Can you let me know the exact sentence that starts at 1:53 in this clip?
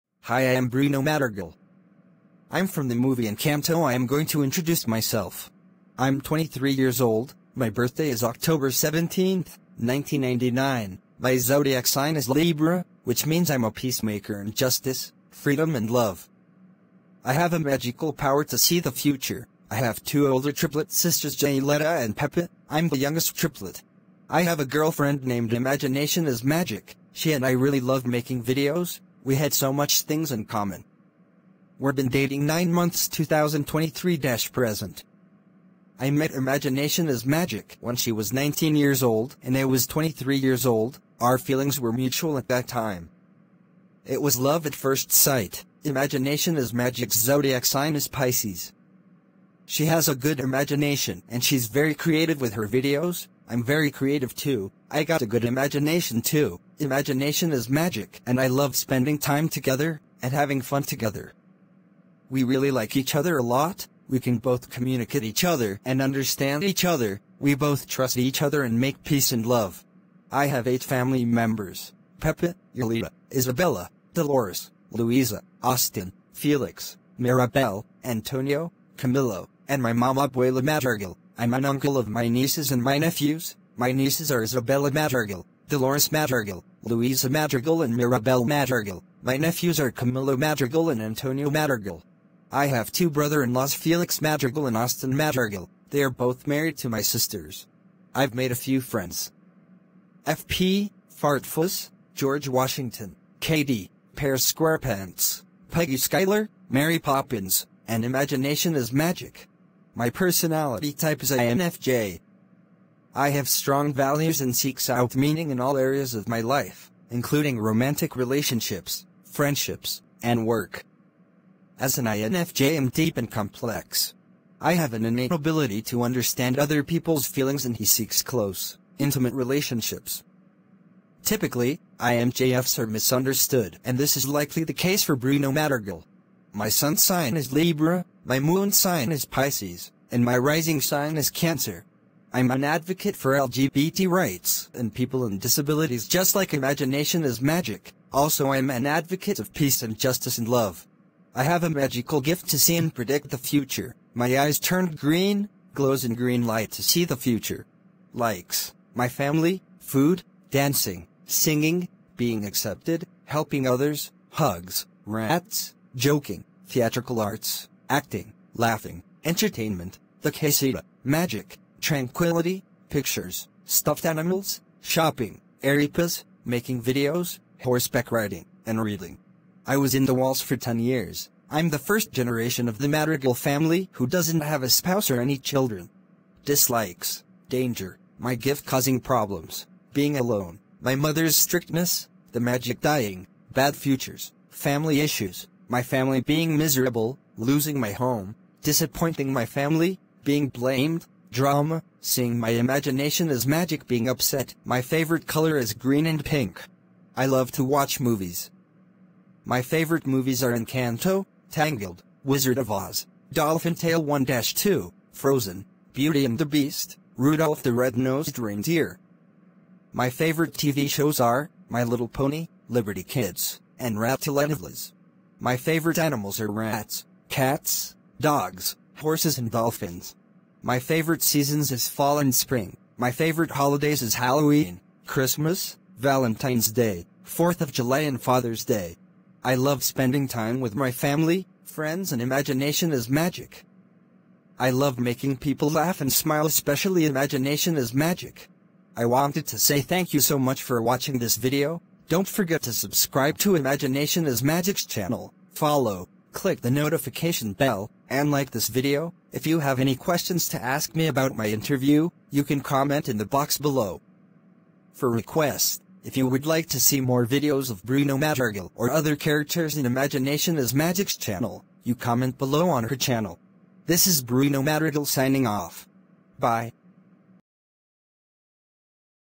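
I have strong values and seeks out meaning in all areas of my life, including romantic relationships, friendships, and work.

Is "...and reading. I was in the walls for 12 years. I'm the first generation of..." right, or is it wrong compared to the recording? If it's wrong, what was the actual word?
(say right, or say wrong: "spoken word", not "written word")
wrong: "10", not "12".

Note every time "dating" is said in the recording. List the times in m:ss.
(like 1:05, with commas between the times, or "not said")
0:32.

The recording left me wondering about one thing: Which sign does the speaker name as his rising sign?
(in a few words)
Cancer.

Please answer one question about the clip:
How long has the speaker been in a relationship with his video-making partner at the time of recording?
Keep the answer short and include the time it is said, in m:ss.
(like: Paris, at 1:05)
9 months, at 0:32.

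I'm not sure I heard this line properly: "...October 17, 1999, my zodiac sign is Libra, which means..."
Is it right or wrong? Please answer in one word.
right.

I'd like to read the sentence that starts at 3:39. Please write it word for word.
My favorite TV shows are My Little Pony, Liberty Kids, and Rattlesnakes.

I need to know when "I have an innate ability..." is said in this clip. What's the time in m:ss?
2:04.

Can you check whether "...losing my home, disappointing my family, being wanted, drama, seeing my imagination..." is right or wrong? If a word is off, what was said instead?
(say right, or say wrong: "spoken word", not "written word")
wrong: "blamed", not "wanted".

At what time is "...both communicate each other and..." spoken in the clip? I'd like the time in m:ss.
1:04.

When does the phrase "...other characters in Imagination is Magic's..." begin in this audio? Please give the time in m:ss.
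4:28.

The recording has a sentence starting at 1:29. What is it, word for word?
My nephews are Camilo Madrigal and Antonio Madrigal.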